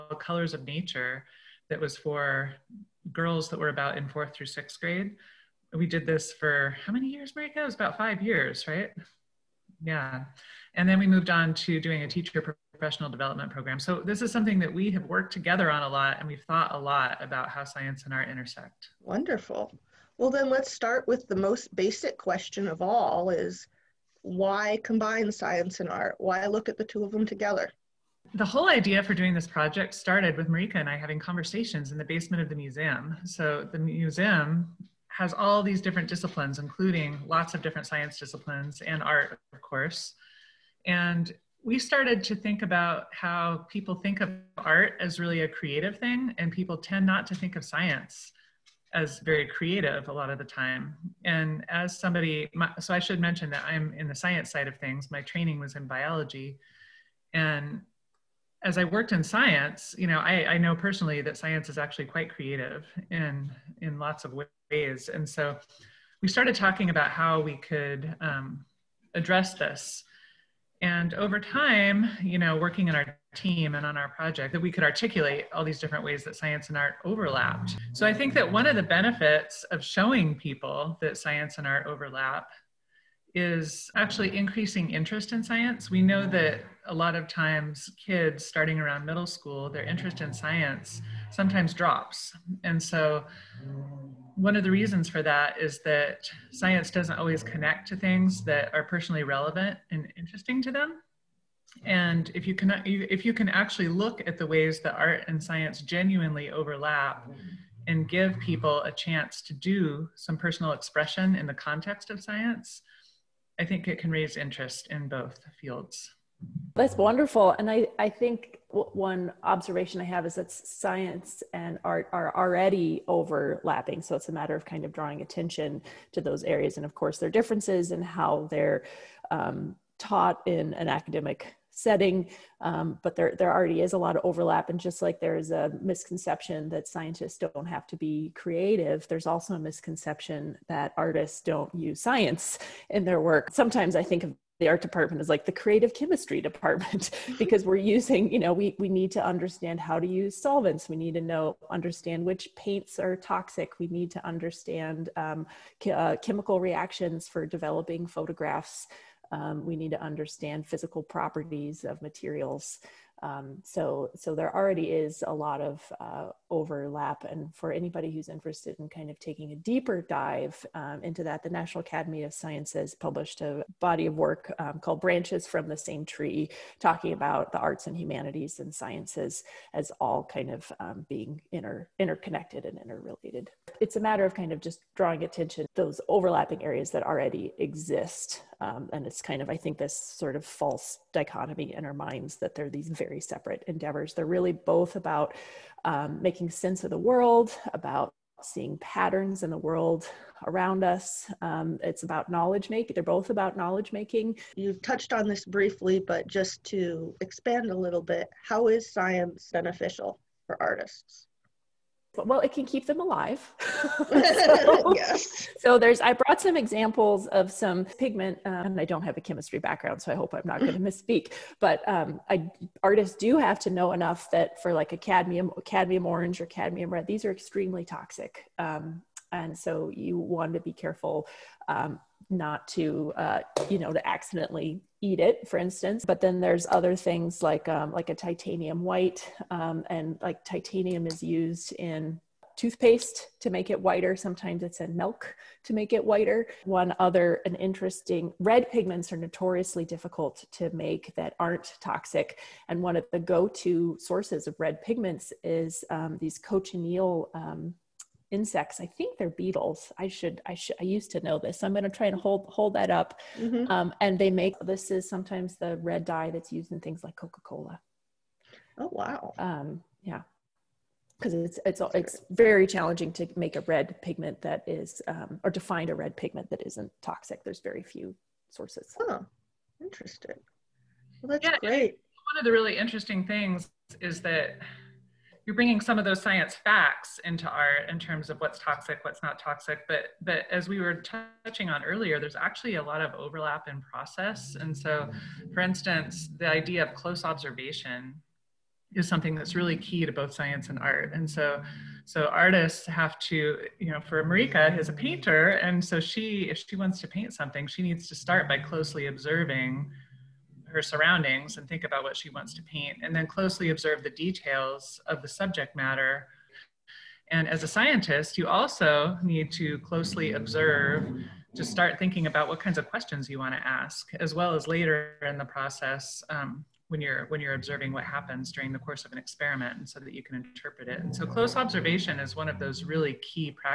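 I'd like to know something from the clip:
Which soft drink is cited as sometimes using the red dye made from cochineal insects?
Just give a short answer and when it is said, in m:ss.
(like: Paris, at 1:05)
Coca-Cola, at 4:27.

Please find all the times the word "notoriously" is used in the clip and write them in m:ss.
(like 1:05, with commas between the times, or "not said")
4:09.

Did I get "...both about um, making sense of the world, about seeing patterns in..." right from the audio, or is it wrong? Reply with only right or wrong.
right.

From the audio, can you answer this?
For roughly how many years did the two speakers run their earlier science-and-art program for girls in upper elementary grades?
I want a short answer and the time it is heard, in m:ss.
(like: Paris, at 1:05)
5, at 0:07.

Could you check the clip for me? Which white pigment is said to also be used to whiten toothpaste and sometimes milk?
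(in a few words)
Titanium white.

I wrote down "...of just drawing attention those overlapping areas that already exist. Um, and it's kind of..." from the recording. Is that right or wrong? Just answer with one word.
right.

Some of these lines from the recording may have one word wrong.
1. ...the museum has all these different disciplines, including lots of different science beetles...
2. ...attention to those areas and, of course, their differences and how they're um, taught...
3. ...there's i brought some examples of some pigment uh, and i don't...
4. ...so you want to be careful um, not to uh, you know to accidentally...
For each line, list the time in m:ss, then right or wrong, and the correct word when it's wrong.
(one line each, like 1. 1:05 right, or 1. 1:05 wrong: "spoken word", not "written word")
1. 0:33 wrong: "disciplines", not "beetles"
2. 2:05 right
3. 3:35 right
4. 3:49 right.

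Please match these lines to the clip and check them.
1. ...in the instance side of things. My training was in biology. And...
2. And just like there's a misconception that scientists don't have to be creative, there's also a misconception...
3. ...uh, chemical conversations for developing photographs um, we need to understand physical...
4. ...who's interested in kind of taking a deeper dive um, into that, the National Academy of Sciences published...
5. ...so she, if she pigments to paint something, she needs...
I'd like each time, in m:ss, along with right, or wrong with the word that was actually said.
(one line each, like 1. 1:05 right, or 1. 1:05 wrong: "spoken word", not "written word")
1. 0:53 wrong: "science", not "instance"
2. 2:14 right
3. 2:35 wrong: "reactions", not "conversations"
4. 2:48 right
5. 5:05 wrong: "wants", not "pigments".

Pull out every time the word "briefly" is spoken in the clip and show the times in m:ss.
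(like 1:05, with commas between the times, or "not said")
3:25.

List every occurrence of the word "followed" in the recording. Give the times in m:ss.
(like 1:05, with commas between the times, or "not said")
not said.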